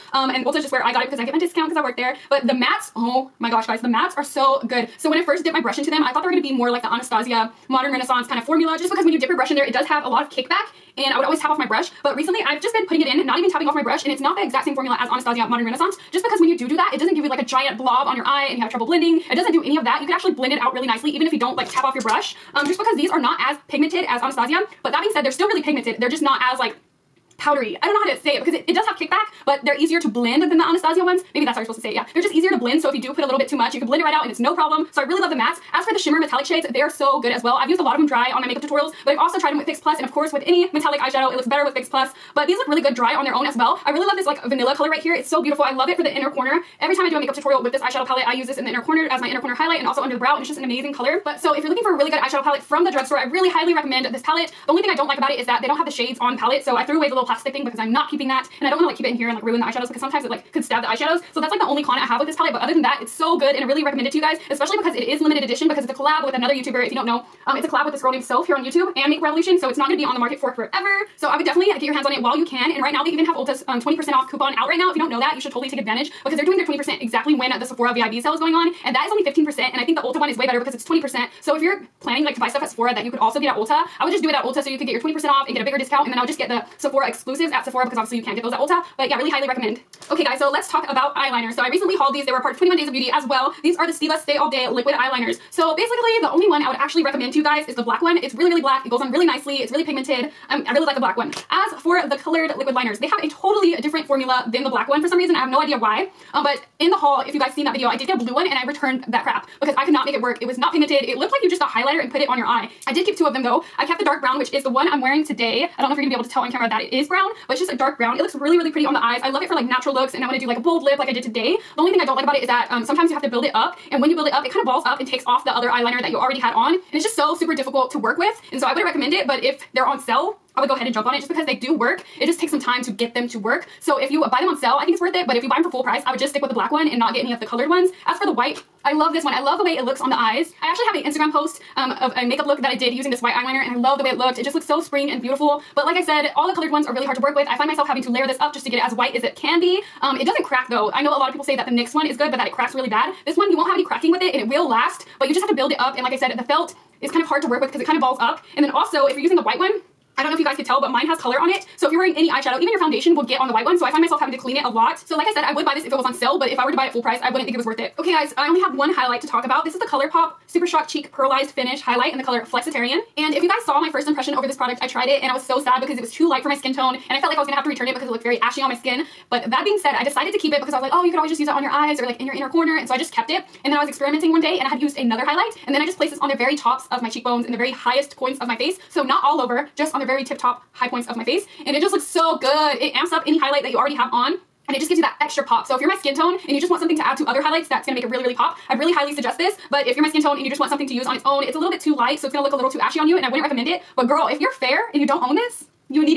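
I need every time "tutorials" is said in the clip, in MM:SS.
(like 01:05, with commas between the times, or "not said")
00:38, 00:47.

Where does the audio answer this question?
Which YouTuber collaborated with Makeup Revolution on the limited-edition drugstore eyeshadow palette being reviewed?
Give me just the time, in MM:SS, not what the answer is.
01:08.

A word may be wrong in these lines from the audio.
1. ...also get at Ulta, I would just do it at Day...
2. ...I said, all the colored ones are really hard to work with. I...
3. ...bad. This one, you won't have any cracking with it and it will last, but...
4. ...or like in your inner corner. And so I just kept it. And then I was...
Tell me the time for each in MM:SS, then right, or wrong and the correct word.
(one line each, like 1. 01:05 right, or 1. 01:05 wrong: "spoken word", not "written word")
1. 01:23 wrong: "Ulta", not "Day"
2. 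02:25 right
3. 02:32 right
4. 03:01 right.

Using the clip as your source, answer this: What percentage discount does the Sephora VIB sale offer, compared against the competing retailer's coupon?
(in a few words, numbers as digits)
15%.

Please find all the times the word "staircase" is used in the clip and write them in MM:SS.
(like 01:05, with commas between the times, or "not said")
not said.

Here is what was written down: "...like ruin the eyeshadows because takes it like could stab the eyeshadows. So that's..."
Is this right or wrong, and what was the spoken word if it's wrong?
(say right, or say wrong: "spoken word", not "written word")
wrong: "sometimes", not "takes".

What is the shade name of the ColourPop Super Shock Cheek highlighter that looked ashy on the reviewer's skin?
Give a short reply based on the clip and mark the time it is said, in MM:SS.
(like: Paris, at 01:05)
Flexitarian, at 02:52.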